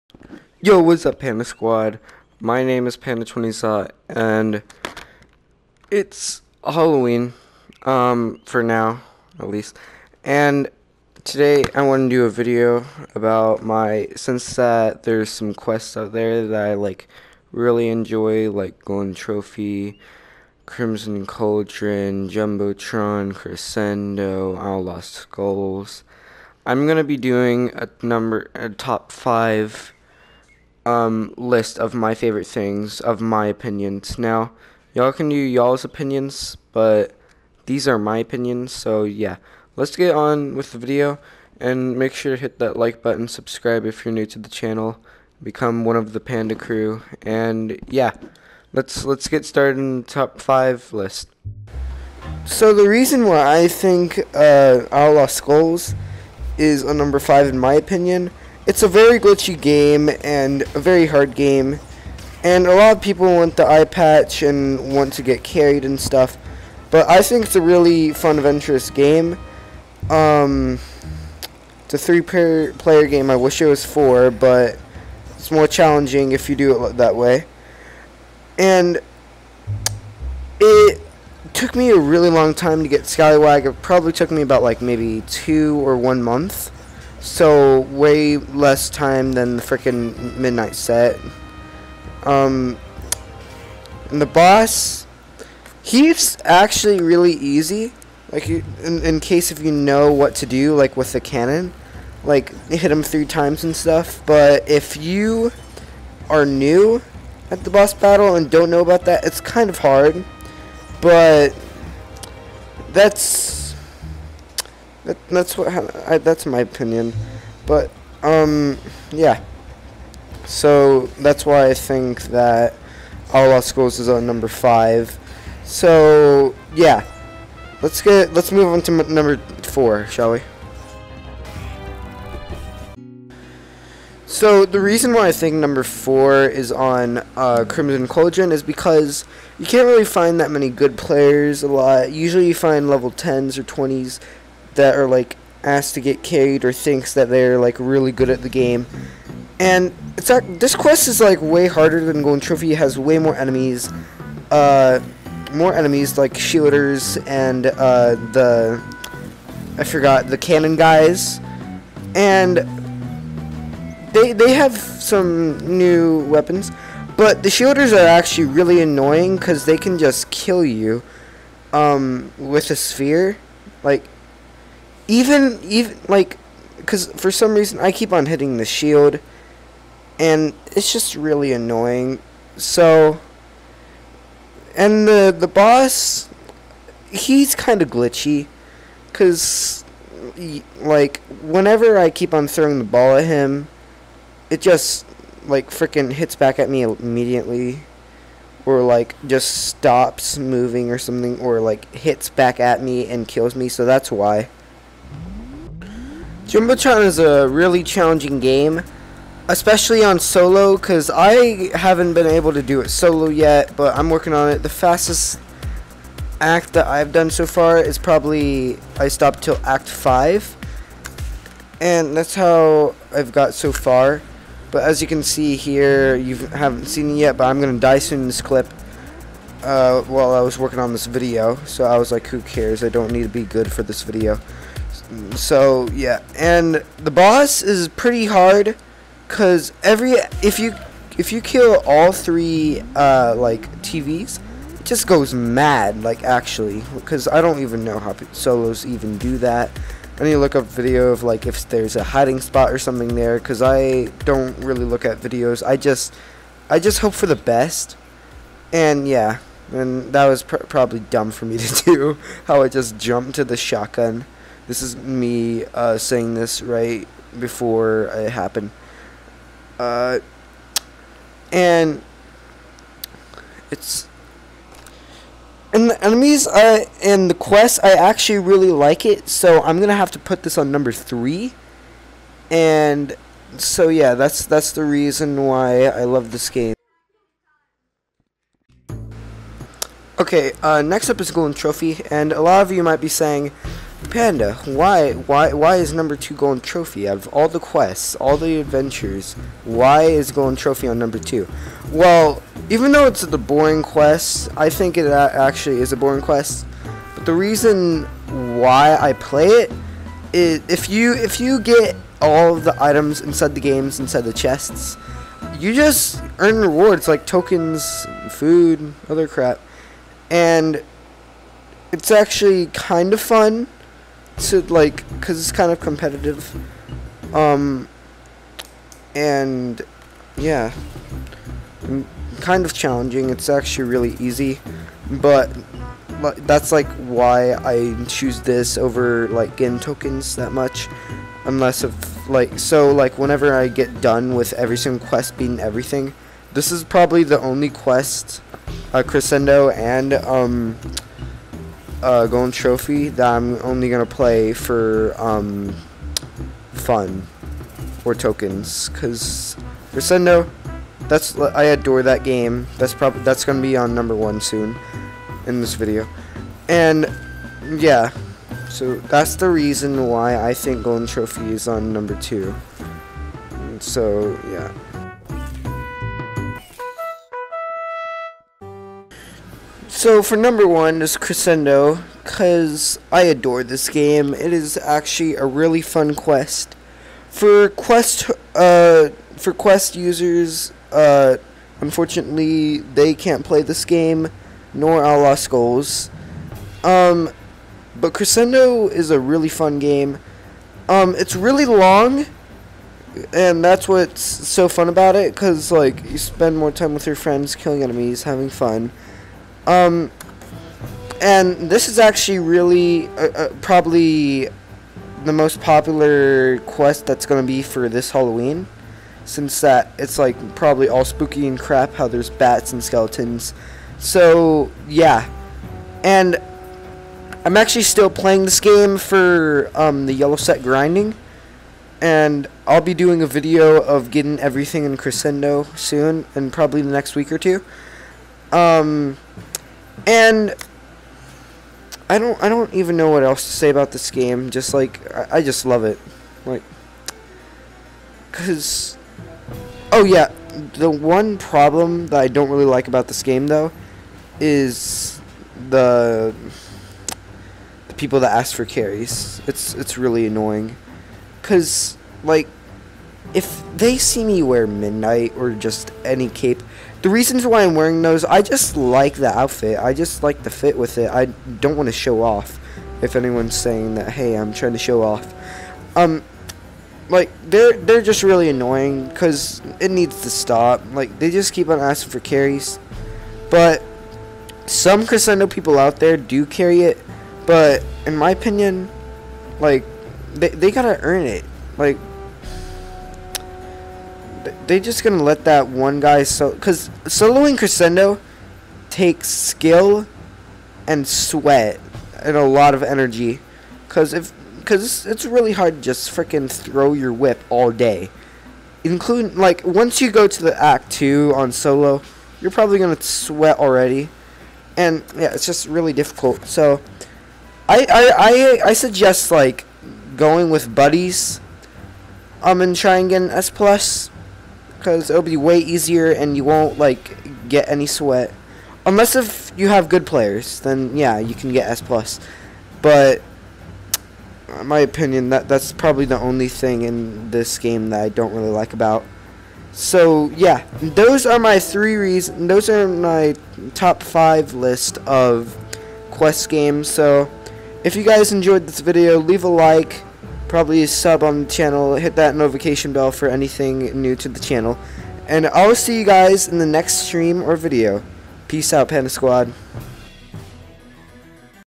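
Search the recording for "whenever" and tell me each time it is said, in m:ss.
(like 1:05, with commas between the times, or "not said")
3:11, 5:43.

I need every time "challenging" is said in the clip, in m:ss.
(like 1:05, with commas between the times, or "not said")
1:15, 3:27, 5:32.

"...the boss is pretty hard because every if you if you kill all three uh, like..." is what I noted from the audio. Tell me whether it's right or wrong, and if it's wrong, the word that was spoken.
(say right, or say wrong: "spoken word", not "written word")
right.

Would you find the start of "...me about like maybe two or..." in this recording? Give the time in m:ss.
1:24.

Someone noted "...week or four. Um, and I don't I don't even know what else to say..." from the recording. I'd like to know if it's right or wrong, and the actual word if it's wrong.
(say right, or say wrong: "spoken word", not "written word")
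wrong: "two", not "four".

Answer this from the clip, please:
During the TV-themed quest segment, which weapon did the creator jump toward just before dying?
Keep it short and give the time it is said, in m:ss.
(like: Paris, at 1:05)
Shotgun, at 4:23.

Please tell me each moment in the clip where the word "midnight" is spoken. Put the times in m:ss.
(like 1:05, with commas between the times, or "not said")
1:30, 7:44.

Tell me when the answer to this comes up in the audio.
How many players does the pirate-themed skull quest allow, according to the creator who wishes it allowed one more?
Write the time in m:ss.
1:11.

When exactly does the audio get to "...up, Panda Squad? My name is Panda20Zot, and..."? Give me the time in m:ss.
0:01.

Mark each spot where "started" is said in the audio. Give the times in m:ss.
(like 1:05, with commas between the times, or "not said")
0:49.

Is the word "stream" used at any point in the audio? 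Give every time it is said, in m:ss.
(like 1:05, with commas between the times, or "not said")
9:17.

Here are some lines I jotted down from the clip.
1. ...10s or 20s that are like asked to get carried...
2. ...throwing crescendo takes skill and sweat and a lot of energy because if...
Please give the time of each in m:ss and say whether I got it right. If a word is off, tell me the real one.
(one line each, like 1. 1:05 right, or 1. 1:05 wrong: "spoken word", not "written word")
1. 2:23 right
2. 8:17 wrong: "soloing", not "throwing".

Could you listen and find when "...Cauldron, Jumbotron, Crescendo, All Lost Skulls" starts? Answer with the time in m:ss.
0:21.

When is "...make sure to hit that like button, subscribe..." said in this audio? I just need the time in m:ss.
0:41.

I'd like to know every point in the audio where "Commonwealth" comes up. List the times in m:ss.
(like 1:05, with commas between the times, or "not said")
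not said.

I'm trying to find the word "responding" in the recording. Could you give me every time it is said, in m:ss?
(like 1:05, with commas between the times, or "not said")
not said.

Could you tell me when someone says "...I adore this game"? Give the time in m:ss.
6:23.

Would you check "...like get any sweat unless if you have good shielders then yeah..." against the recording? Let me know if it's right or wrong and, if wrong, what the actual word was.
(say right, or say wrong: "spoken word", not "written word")
wrong: "players", not "shielders".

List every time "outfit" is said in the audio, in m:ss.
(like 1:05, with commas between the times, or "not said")
7:49.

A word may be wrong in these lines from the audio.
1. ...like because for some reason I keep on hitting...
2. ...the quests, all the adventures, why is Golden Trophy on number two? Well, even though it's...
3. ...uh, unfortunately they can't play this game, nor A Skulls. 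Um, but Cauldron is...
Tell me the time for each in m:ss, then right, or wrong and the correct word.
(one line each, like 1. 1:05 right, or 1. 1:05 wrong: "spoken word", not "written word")
1. 2:56 right
2. 4:57 right
3. 6:30 wrong: "Crescendo", not "Cauldron".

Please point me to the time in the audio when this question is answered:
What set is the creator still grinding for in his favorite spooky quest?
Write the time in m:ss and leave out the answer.
7:10.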